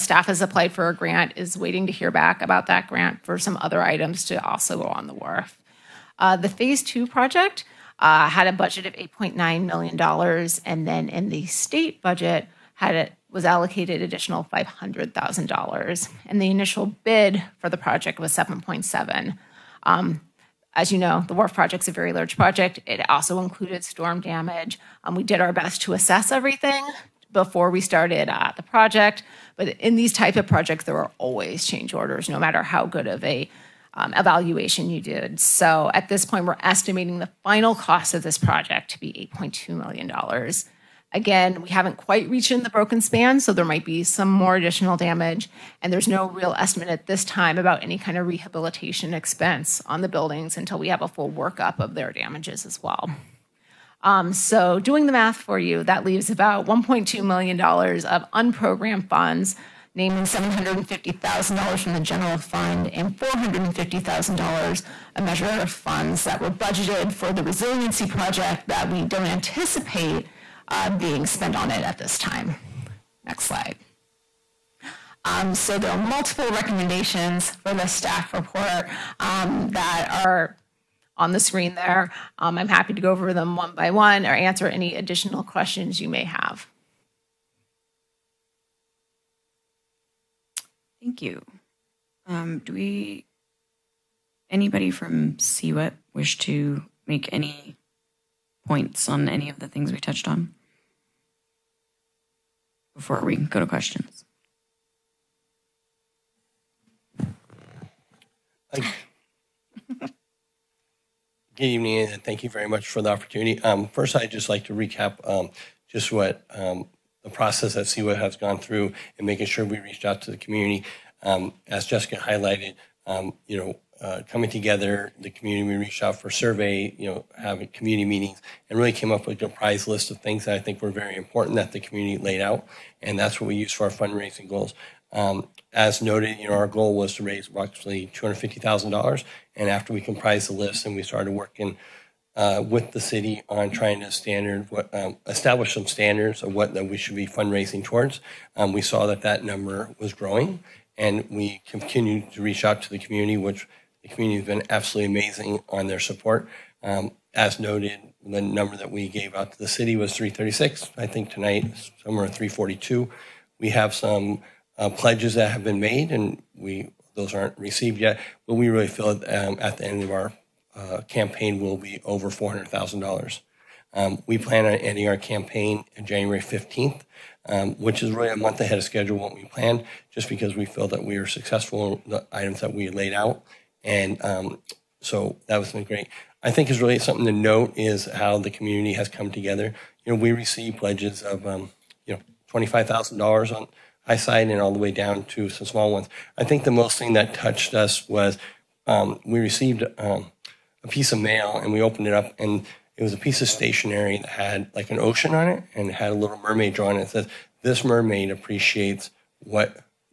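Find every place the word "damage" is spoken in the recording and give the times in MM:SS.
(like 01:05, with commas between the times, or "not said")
00:24, 00:44, 00:52.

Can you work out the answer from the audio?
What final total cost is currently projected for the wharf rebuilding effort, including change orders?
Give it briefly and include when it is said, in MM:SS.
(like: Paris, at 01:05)
$8.2 million, at 00:39.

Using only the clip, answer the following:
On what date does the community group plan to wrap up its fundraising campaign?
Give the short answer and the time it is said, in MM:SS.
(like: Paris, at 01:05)
January 15, at 02:56.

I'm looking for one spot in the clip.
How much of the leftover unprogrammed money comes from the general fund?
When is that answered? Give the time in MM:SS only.
01:00.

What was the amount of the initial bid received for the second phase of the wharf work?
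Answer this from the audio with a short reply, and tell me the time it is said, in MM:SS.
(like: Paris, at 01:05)
$7.7 million, at 00:18.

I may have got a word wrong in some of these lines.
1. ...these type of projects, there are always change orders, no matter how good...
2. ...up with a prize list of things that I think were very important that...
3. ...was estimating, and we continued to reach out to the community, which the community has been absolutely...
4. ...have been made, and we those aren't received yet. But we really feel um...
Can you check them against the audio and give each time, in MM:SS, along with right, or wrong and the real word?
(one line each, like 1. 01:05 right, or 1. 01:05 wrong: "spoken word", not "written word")
1. 00:29 right
2. 02:09 right
3. 02:29 wrong: "growing", not "estimating"
4. 02:45 right.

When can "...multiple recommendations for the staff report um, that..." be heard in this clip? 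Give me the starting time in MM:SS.
01:15.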